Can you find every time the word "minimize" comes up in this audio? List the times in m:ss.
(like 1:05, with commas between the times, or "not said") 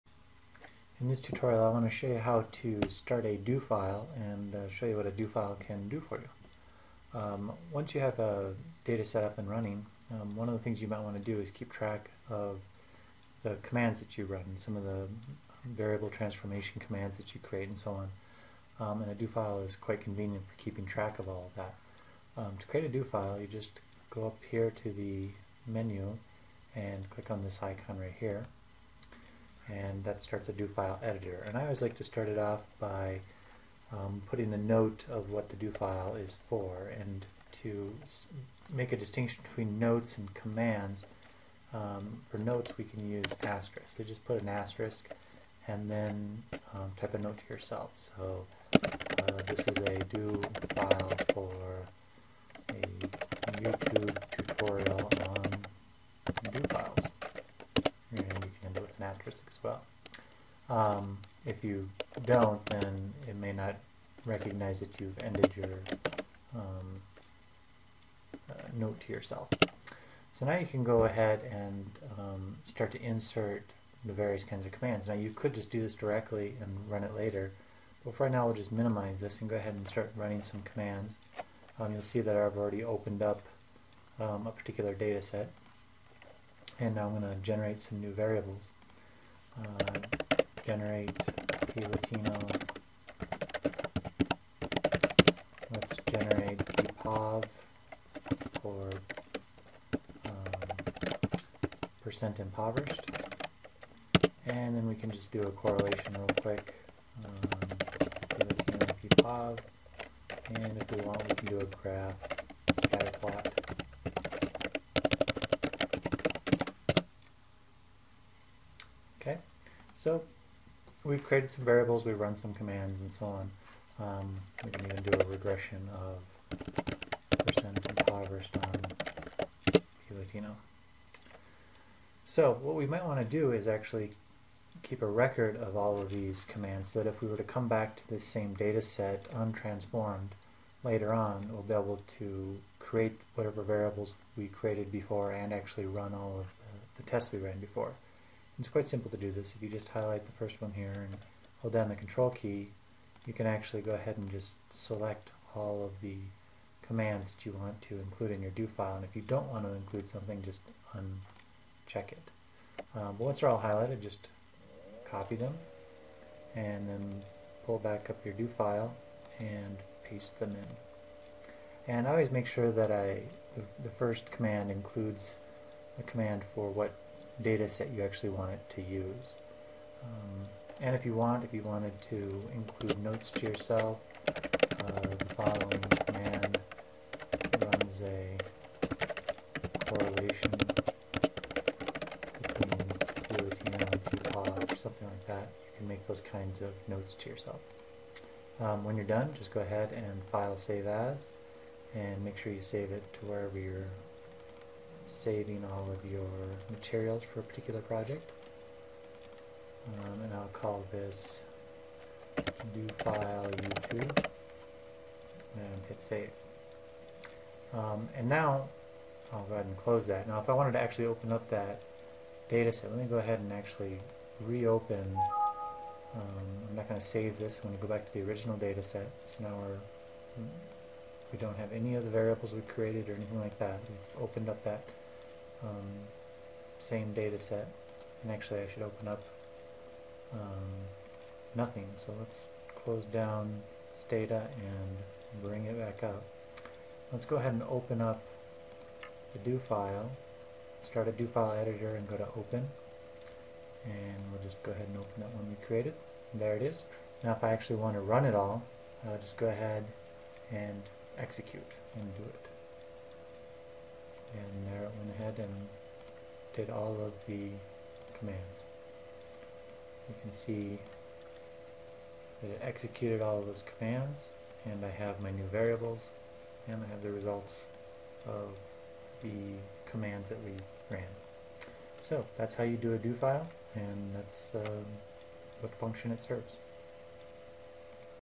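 1:18.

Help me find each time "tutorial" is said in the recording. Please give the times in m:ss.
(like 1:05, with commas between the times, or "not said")
0:01, 0:54.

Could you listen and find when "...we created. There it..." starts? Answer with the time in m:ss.
4:15.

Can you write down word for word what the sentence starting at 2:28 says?
It's quite simple to do this.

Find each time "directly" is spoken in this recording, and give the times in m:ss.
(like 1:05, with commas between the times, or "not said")
1:15.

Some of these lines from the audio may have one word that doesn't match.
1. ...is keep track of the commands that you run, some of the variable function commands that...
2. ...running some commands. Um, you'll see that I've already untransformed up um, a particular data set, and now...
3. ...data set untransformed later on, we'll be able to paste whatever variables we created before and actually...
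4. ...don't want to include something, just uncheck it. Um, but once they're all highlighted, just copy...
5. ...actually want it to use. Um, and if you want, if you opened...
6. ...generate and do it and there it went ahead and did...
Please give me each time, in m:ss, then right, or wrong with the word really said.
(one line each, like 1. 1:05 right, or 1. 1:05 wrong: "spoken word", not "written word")
1. 0:11 wrong: "transformation", not "function"
2. 1:20 wrong: "opened", not "untransformed"
3. 2:18 wrong: "create", not "paste"
4. 2:39 right
5. 2:58 wrong: "wanted", not "opened"
6. 4:21 wrong: "execute", not "generate".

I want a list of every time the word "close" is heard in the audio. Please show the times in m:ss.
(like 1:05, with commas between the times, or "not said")
3:39, 4:02.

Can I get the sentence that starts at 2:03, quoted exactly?
Um, we can even do a regression of percent impoverished on Latino.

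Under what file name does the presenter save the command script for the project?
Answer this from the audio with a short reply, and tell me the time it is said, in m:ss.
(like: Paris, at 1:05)
do file 2, at 3:32.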